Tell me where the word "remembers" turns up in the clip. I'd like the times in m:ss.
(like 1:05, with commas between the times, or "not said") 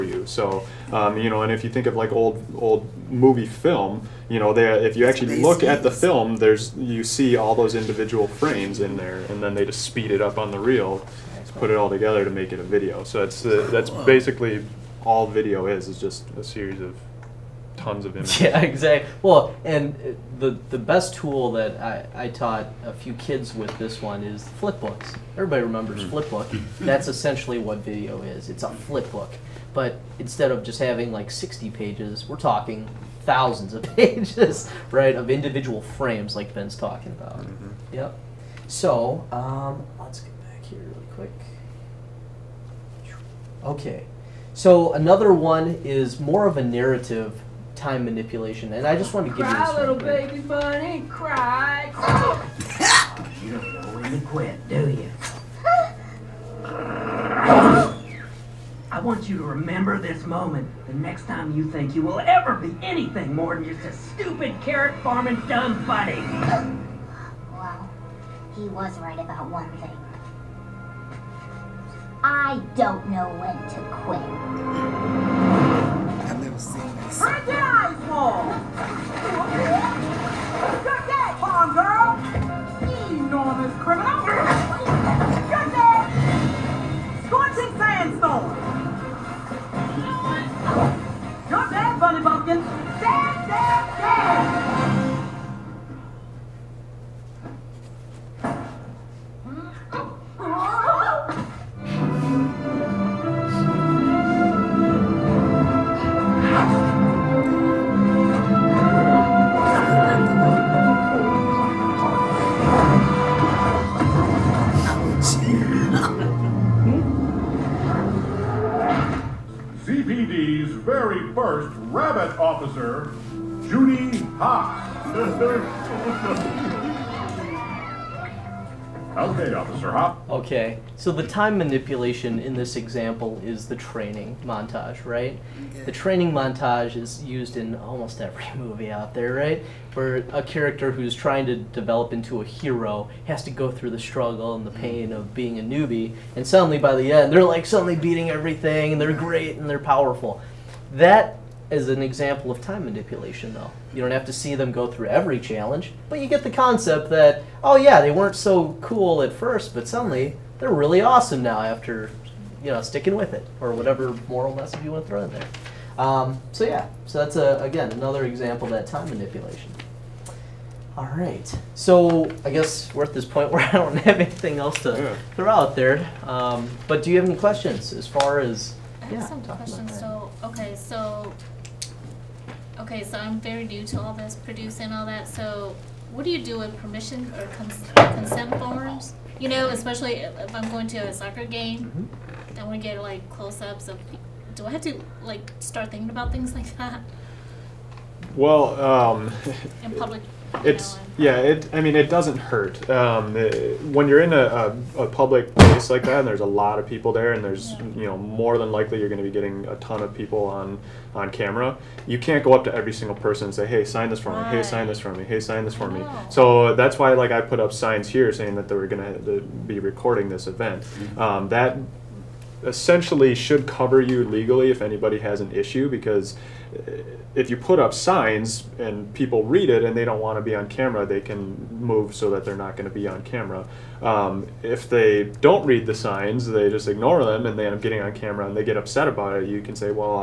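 0:25, 0:59.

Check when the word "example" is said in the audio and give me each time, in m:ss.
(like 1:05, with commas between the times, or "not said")
2:12, 2:32, 2:48.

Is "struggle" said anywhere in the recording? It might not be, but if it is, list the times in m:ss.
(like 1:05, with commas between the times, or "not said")
2:23.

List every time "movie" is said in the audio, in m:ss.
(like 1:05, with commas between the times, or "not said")
0:03, 2:18.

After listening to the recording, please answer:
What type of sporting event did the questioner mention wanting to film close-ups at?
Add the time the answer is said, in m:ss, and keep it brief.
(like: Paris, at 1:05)
soccer game, at 3:11.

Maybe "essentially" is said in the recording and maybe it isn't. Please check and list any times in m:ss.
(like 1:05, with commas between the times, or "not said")
0:27, 3:42.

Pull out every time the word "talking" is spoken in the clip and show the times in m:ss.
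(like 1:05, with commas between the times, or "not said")
0:32, 0:36.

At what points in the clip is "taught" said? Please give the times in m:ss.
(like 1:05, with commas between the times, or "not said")
0:22.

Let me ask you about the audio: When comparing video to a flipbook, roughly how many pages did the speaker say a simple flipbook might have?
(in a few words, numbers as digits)
60.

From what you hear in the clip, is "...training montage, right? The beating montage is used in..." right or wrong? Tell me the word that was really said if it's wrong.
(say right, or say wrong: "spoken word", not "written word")
wrong: "training", not "beating".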